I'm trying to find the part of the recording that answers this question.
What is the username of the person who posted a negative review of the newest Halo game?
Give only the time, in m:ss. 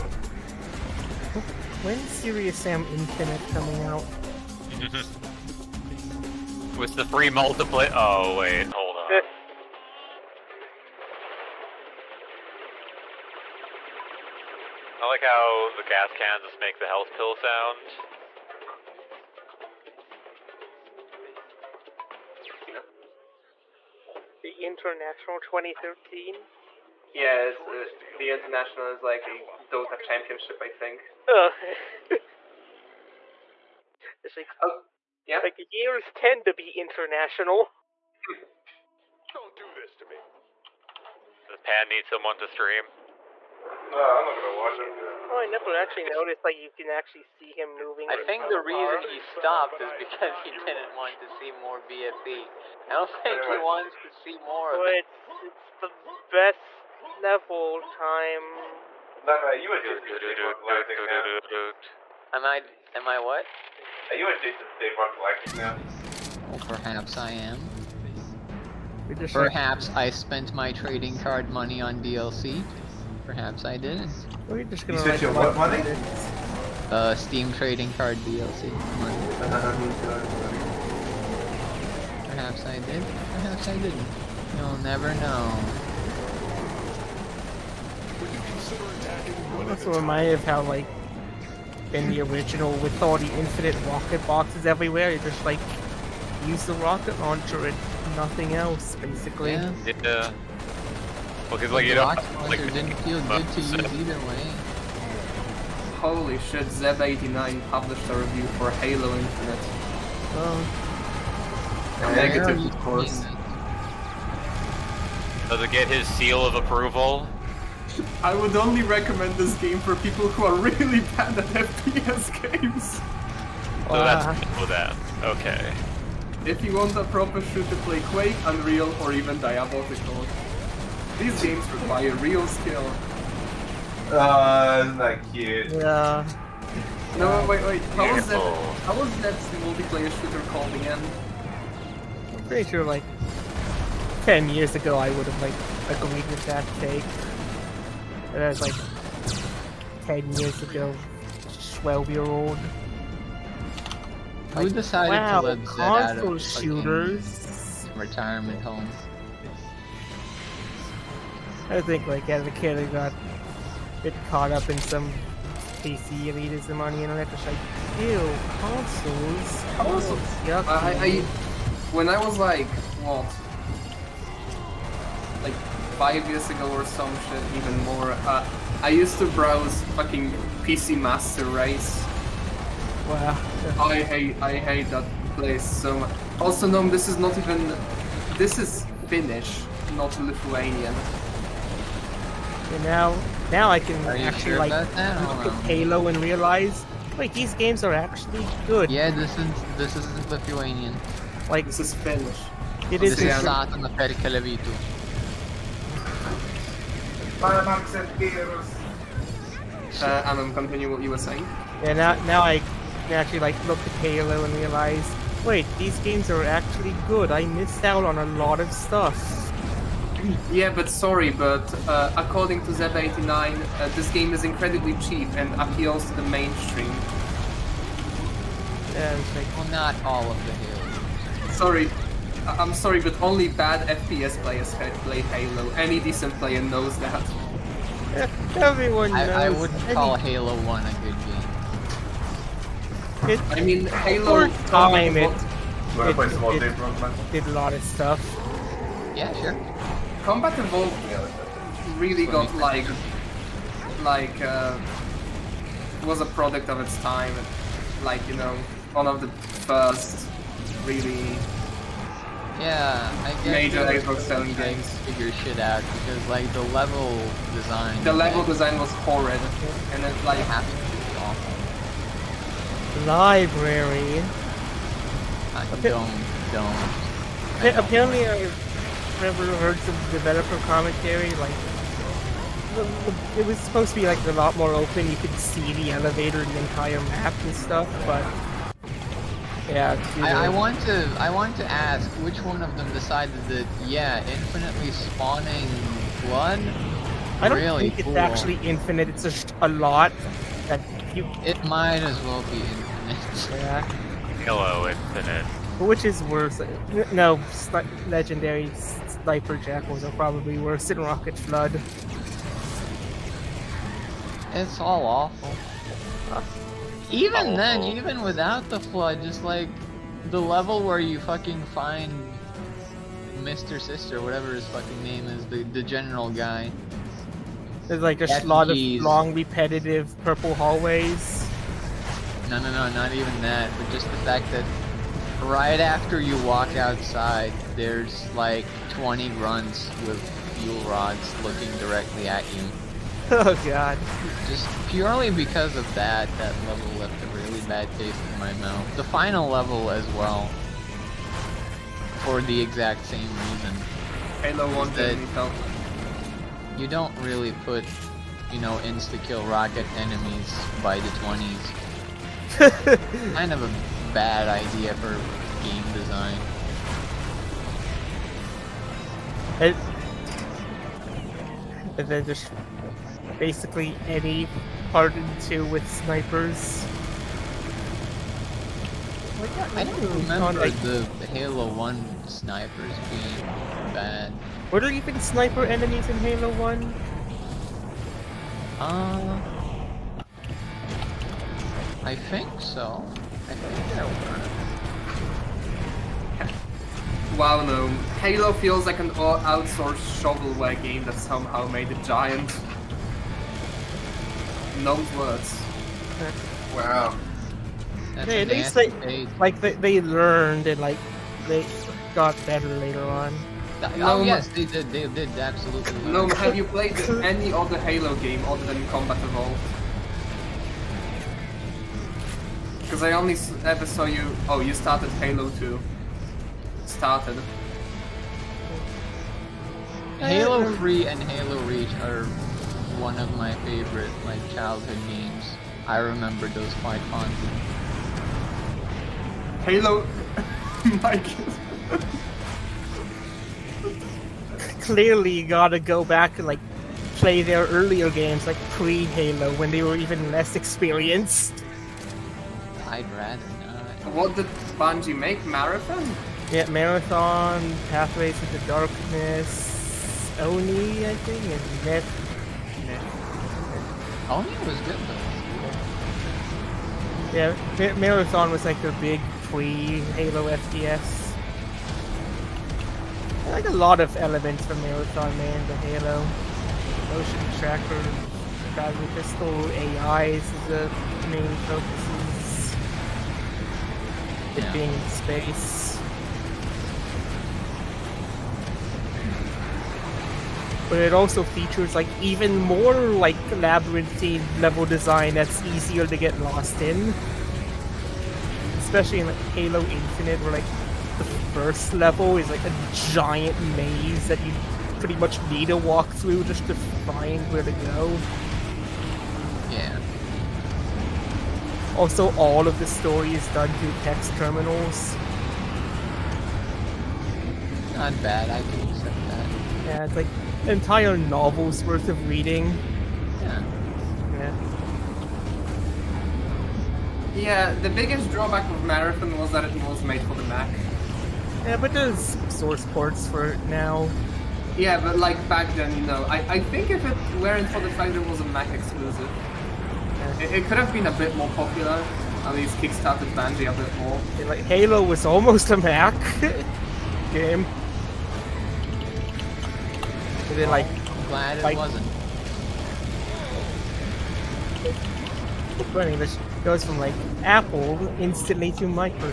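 1:46.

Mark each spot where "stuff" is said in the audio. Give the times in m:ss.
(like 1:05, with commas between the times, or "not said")
3:38, 4:07, 4:47.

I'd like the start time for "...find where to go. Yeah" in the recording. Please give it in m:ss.
8:27.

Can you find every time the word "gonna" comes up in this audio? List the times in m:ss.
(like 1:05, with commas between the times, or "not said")
0:44, 1:14.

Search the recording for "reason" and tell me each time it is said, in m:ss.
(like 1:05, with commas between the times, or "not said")
0:48, 5:53.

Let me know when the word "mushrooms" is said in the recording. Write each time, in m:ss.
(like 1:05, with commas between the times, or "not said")
not said.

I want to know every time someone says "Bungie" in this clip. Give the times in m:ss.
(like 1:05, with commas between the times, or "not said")
7:34, 9:03.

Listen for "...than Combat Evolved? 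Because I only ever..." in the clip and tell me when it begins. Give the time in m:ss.
6:58.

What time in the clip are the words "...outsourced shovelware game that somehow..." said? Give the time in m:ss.
6:39.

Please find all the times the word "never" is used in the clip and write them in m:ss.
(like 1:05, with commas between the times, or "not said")
0:45, 1:24, 4:39.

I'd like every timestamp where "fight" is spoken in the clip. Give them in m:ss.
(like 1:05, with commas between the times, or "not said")
9:11.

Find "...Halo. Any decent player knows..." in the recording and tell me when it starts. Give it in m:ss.
3:55.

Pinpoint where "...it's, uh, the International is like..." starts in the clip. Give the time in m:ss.
0:27.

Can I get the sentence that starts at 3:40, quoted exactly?
Yeah, but sorry, but uh, according to Zeb89, uh, this game is incredibly cheap and appeals to the mainstream.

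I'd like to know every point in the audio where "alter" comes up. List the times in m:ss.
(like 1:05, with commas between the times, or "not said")
not said.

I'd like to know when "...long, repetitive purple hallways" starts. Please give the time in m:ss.
5:29.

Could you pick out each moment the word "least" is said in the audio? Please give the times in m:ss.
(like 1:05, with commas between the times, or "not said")
6:48, 9:02.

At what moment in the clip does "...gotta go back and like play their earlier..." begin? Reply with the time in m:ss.
7:25.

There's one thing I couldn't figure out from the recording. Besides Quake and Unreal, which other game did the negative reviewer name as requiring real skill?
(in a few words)
Diablo.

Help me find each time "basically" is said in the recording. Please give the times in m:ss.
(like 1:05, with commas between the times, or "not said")
1:38, 6:13.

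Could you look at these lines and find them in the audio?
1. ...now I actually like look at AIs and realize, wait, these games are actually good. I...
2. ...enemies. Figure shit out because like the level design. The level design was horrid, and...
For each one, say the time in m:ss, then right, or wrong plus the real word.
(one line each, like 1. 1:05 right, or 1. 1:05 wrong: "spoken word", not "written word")
1. 3:32 wrong: "Halo", not "AIs"
2. 4:24 wrong: "games", not "enemies".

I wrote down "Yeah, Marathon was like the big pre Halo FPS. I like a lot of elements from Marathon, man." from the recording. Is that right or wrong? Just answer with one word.
right.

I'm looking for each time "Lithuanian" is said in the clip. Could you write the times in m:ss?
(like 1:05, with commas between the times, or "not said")
3:10, 3:20.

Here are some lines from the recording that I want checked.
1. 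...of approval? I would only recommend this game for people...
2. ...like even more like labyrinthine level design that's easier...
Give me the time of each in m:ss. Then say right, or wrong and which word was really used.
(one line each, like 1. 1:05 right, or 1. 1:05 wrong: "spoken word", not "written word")
1. 1:56 right
2. 8:11 right.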